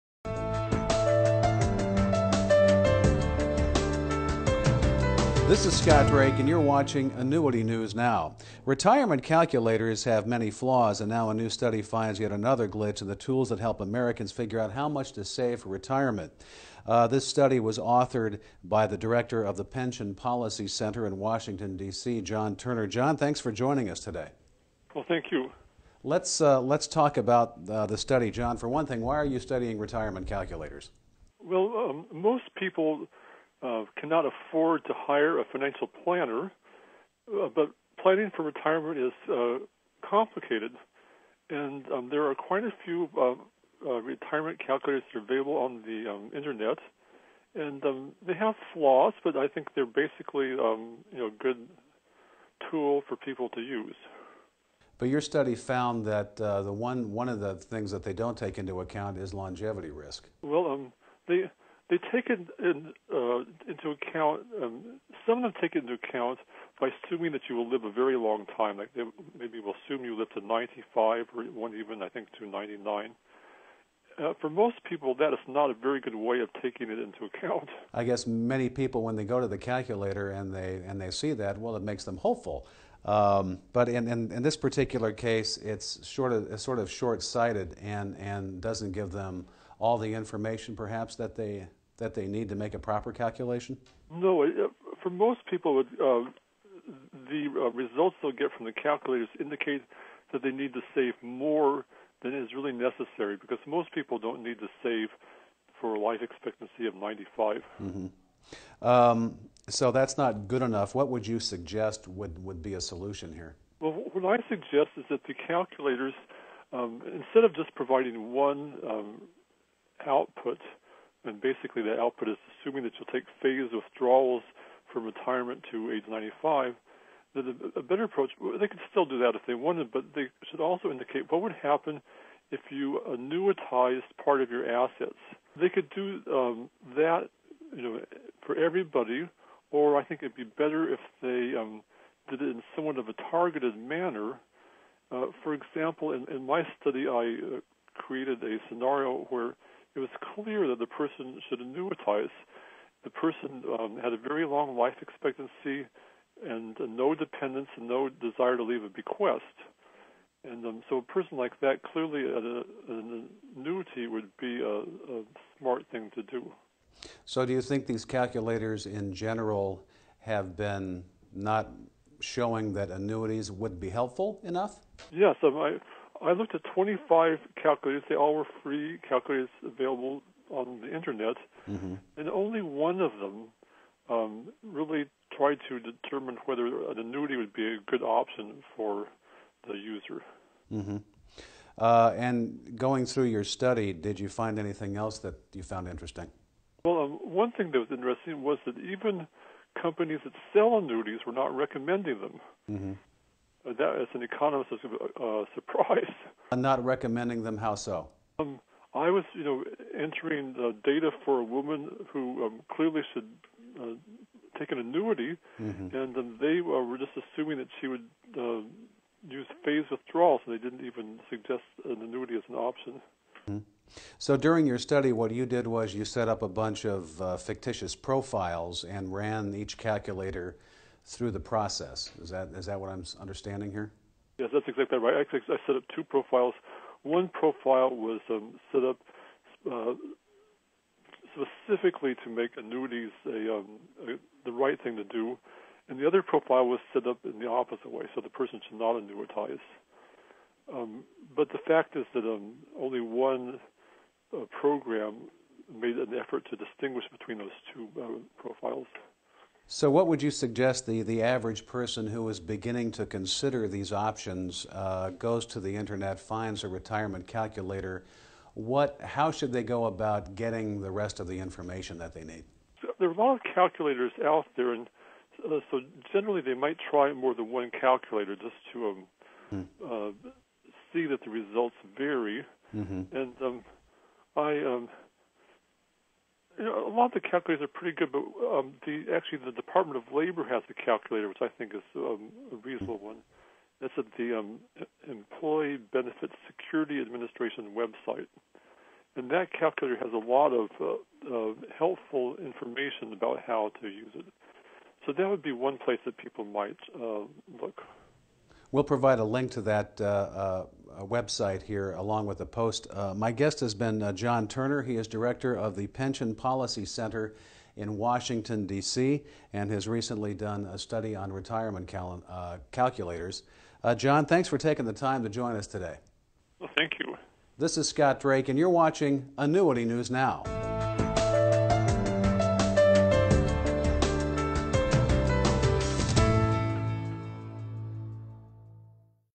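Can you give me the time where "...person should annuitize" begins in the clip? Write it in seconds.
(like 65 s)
150 s.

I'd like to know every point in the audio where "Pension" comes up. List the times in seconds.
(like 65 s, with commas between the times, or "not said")
19 s, 315 s.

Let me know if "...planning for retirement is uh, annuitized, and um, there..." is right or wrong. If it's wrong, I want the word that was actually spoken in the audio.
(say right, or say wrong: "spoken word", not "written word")
wrong: "complicated", not "annuitized".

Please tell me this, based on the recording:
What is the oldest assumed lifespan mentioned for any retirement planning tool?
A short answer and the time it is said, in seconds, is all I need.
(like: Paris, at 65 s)
99, at 72 s.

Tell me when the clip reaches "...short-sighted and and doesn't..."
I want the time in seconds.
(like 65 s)
86 s.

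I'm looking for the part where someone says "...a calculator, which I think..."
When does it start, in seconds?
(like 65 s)
290 s.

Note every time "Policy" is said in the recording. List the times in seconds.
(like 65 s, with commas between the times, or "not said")
20 s, 316 s.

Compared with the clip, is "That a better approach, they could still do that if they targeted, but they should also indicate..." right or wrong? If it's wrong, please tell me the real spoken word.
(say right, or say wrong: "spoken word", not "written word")
wrong: "wanted", not "targeted".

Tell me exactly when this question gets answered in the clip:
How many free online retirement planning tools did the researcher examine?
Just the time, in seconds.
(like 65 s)
176 s.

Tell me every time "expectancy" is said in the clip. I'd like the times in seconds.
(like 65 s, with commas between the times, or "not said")
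106 s, 155 s.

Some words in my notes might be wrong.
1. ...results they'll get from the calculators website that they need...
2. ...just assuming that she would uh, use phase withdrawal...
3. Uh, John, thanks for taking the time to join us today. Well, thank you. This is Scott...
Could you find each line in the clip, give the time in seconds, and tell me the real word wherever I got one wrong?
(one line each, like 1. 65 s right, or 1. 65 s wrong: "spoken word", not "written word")
1. 97 s wrong: "indicate", not "website"
2. 216 s right
3. 323 s right.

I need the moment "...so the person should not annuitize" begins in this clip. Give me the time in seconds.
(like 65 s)
248 s.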